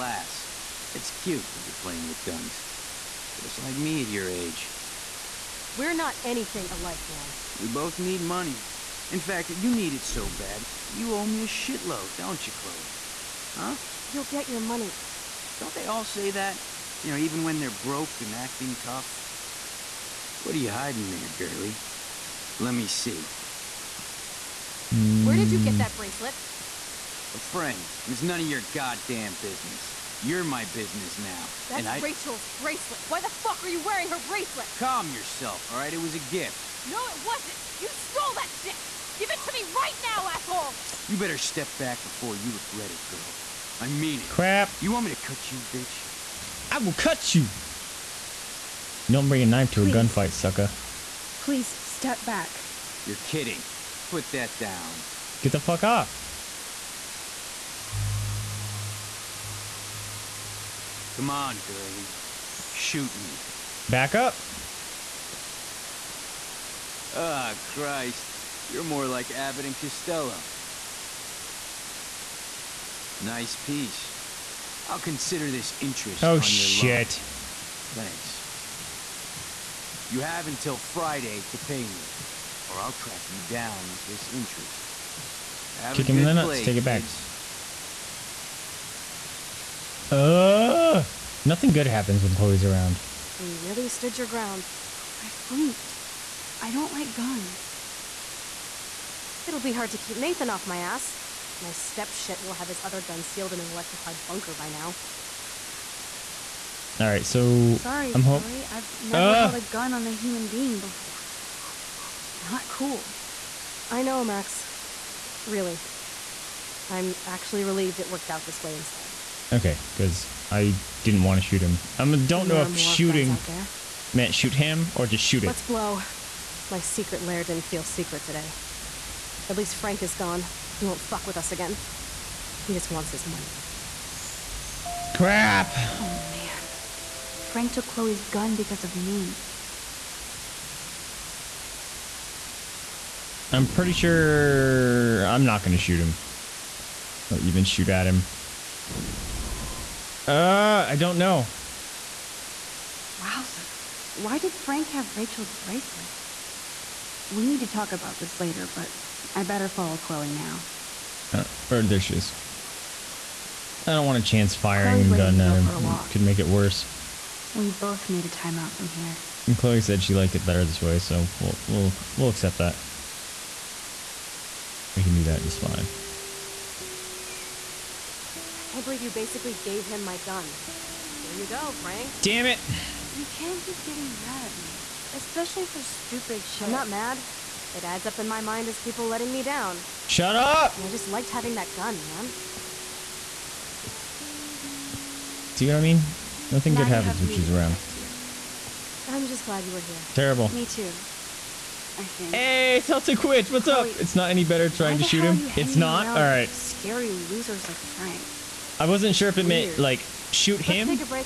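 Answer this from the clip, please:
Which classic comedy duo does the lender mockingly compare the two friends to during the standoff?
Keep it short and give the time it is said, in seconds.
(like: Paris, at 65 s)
Abbott and Costello, at 69 s.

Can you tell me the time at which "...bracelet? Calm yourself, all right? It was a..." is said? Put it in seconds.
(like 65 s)
34 s.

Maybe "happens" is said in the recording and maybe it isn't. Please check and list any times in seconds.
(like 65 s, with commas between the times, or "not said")
91 s, 196 s.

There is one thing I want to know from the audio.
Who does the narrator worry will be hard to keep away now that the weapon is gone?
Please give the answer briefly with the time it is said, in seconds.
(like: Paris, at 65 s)
Nathan, at 100 s.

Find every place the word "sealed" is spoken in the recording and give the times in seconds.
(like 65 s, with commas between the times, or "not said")
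103 s.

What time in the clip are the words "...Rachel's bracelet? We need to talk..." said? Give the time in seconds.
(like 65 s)
155 s.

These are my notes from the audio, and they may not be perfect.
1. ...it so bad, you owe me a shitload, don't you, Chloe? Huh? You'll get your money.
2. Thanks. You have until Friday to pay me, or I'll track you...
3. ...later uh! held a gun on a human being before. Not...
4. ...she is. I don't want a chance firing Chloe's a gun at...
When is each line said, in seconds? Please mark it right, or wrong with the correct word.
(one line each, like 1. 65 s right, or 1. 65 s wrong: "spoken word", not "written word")
1. 9 s right
2. 78 s right
3. 109 s wrong: "never", not "later"
4. 161 s right.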